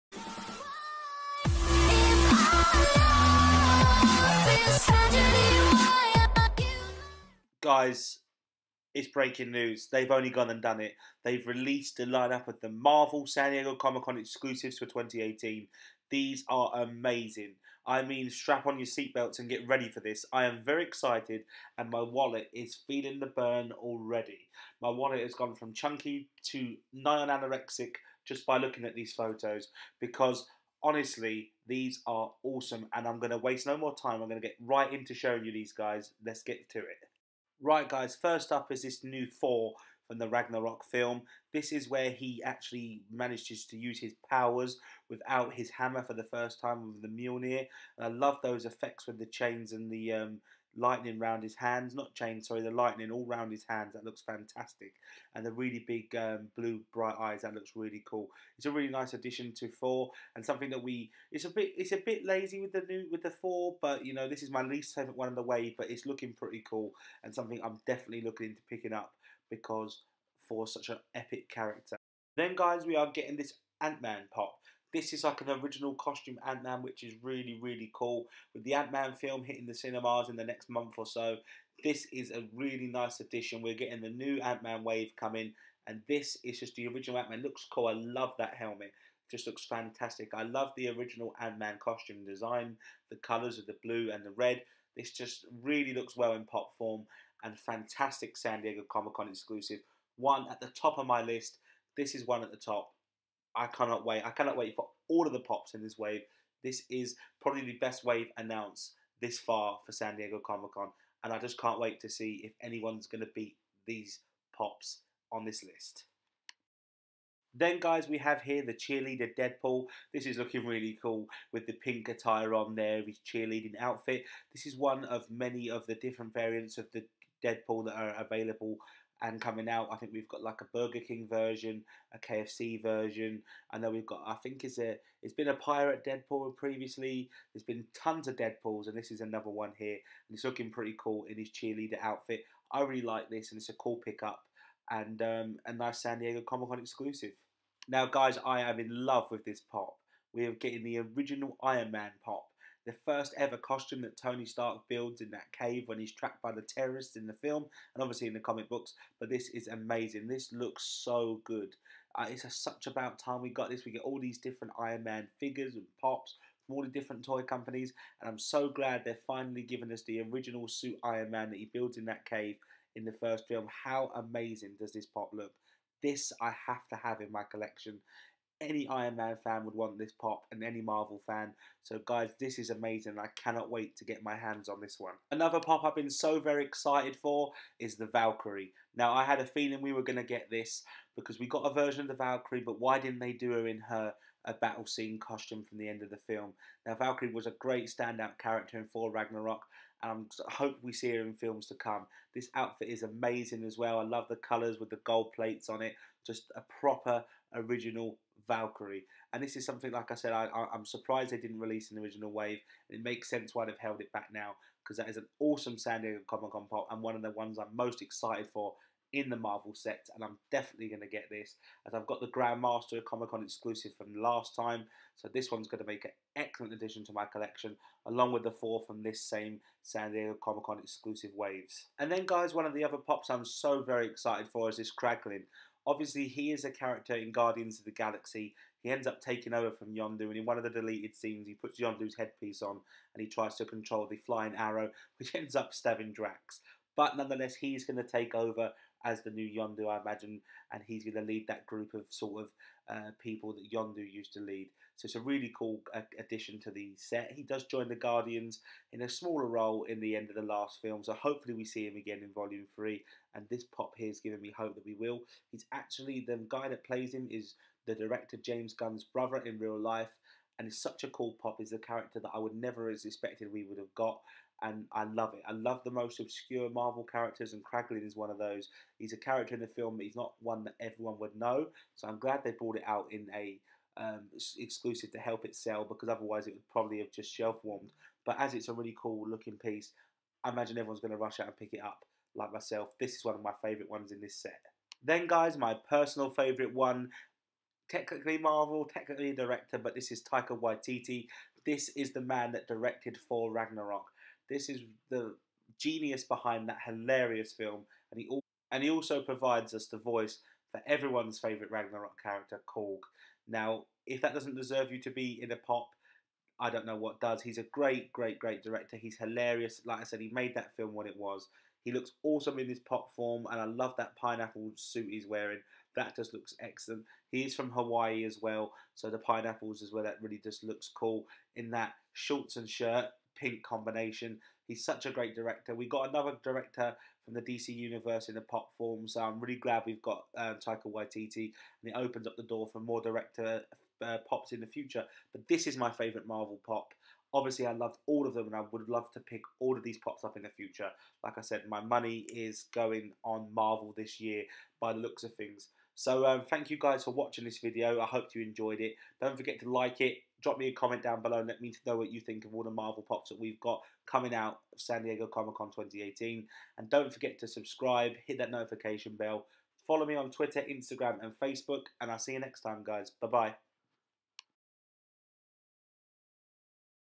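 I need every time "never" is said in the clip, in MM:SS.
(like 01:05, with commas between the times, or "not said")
04:32.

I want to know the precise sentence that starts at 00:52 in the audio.
sorry, the lightning all round his hands.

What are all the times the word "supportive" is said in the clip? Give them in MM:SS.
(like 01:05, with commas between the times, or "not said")
not said.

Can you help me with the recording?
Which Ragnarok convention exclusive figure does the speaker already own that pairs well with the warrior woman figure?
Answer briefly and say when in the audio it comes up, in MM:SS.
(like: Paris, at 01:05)
The Grandmaster, at 03:42.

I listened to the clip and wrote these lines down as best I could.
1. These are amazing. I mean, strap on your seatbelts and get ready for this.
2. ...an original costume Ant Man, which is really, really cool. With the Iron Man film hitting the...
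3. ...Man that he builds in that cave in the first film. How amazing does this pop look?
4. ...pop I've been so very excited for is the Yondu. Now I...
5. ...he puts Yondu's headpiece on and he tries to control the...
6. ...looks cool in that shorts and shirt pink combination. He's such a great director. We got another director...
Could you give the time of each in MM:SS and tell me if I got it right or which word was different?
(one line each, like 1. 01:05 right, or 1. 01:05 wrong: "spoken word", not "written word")
1. 00:16 right
2. 01:15 wrong: "Ant", not "Iron"
3. 02:51 right
4. 03:05 wrong: "Valkyrie", not "Yondu"
5. 04:01 right
6. 05:30 right.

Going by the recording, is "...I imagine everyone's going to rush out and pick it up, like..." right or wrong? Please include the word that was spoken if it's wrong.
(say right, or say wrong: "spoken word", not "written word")
right.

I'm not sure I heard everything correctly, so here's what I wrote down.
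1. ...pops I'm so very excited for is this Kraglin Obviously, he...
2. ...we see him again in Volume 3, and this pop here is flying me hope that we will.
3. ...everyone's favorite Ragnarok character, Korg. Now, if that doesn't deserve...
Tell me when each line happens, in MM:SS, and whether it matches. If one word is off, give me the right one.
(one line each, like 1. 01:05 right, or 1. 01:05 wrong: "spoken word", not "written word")
1. 03:52 right
2. 04:21 wrong: "giving", not "flying"
3. 05:10 right.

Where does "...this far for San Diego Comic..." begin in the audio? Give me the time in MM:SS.
01:49.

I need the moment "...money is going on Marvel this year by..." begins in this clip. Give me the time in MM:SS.
05:51.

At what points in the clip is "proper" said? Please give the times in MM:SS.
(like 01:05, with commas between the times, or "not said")
03:26.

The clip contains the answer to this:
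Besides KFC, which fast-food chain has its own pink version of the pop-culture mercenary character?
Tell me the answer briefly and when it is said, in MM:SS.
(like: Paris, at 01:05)
Burger King, at 02:10.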